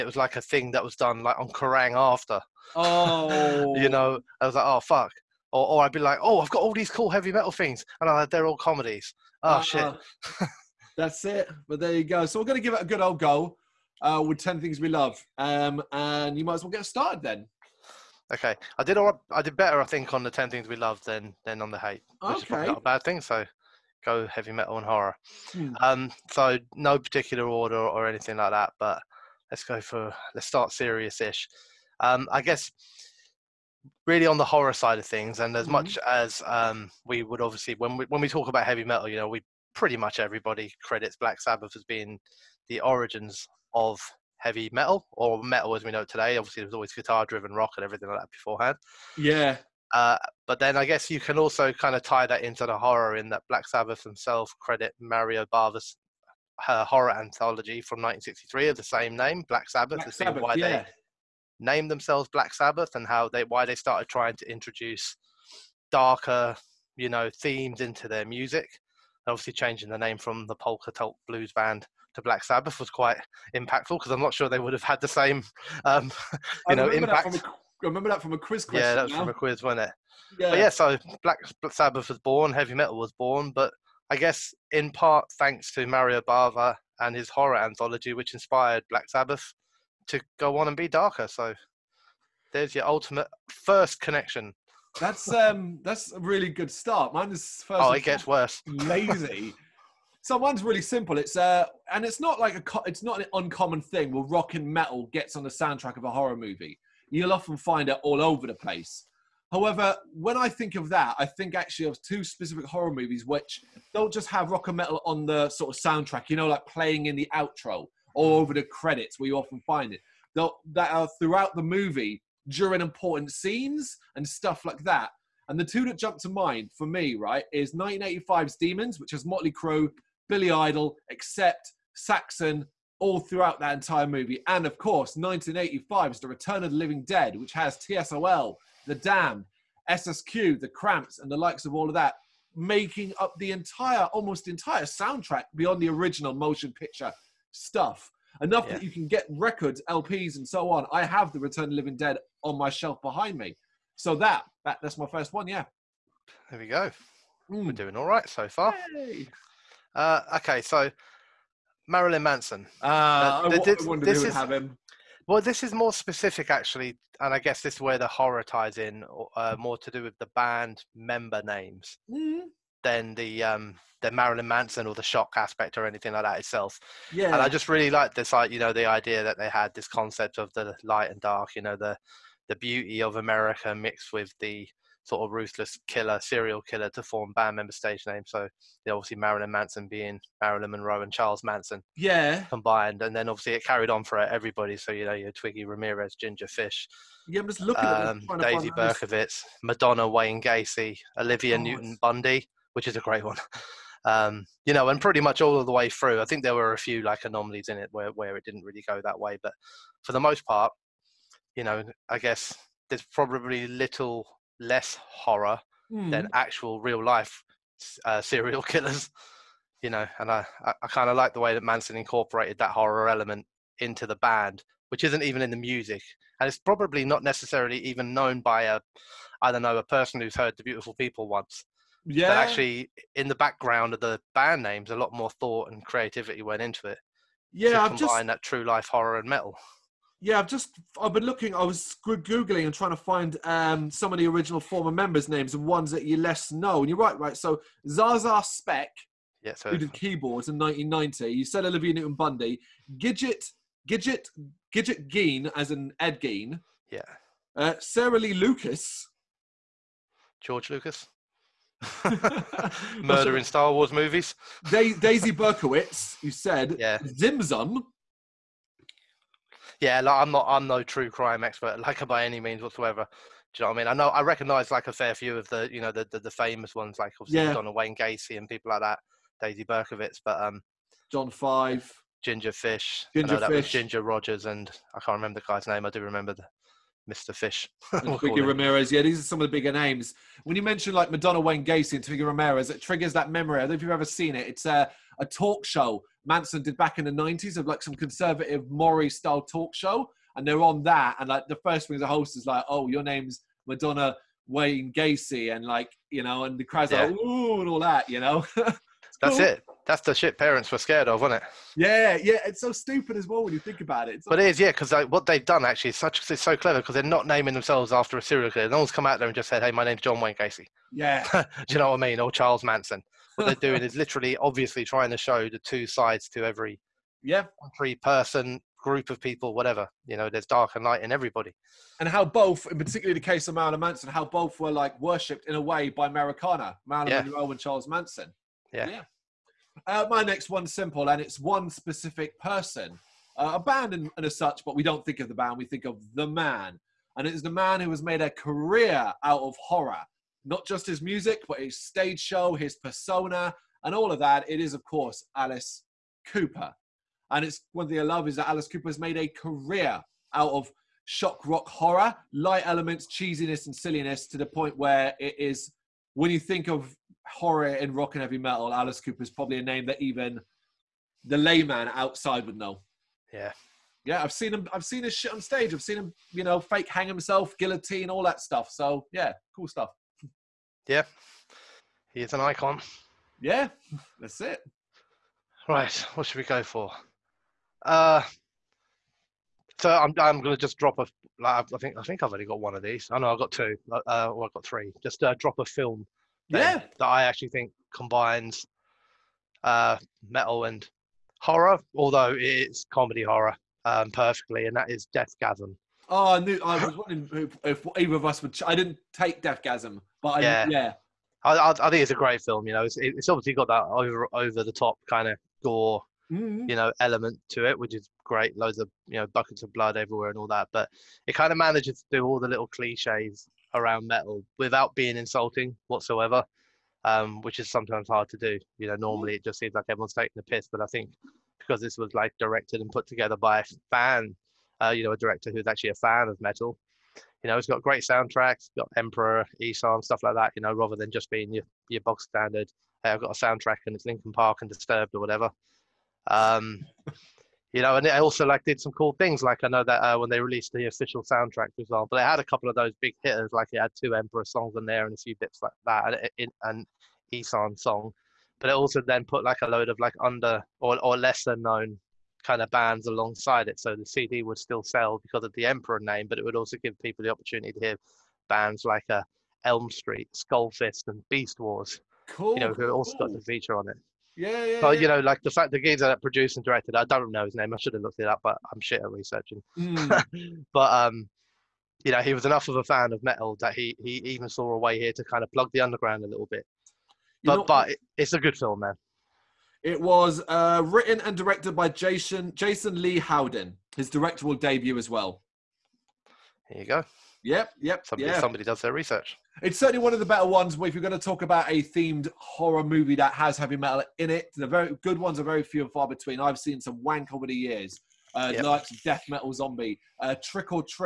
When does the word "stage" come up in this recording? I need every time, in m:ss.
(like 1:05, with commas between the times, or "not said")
3:07, 5:51, 6:15.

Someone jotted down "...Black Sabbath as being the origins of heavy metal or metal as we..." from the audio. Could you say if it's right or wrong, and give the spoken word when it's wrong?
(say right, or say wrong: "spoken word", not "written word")
right.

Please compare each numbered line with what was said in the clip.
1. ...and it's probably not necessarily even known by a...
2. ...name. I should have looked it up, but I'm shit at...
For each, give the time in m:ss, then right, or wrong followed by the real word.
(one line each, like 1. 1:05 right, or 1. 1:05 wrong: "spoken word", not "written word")
1. 3:46 right
2. 7:57 right.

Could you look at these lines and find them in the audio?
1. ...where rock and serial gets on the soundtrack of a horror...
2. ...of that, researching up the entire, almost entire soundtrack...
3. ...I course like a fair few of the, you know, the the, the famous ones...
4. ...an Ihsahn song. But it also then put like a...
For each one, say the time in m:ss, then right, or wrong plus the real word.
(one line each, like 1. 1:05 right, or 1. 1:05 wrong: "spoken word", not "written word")
1. 1:44 wrong: "metal", not "serial"
2. 2:21 wrong: "making", not "researching"
3. 4:34 wrong: "recognise", not "course"
4. 7:36 right.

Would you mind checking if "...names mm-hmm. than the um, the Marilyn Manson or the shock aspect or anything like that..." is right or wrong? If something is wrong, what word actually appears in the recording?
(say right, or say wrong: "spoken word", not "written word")
right.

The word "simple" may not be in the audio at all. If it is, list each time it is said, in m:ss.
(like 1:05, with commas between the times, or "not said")
1:40, 5:40.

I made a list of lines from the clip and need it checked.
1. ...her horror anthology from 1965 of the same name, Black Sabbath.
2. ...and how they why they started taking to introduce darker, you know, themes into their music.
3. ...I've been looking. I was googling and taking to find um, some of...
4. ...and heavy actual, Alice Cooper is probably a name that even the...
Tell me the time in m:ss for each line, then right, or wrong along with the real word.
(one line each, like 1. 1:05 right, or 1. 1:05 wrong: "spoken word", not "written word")
1. 0:56 wrong: "1963", not "1965"
2. 1:02 wrong: "trying", not "taking"
3. 4:01 wrong: "trying", not "taking"
4. 6:08 wrong: "metal", not "actual".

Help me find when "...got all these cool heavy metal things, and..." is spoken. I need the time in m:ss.
0:06.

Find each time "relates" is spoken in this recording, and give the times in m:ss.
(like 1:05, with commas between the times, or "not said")
not said.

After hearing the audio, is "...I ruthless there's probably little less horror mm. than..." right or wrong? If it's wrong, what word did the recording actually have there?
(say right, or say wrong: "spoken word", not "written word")
wrong: "guess", not "ruthless".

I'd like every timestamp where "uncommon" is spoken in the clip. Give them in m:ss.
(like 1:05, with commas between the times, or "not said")
1:43.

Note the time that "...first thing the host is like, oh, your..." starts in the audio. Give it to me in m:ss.
5:01.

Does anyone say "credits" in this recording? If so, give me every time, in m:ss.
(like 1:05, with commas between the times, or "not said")
0:40, 0:54, 1:58.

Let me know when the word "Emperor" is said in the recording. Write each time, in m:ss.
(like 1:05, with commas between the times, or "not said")
7:18, 7:34, 7:45.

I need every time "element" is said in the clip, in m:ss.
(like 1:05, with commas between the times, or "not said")
3:43, 6:02, 6:56.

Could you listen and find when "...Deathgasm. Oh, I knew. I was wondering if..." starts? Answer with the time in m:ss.
6:45.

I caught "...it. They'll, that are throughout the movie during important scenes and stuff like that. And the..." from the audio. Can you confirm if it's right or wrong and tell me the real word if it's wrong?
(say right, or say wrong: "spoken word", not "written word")
right.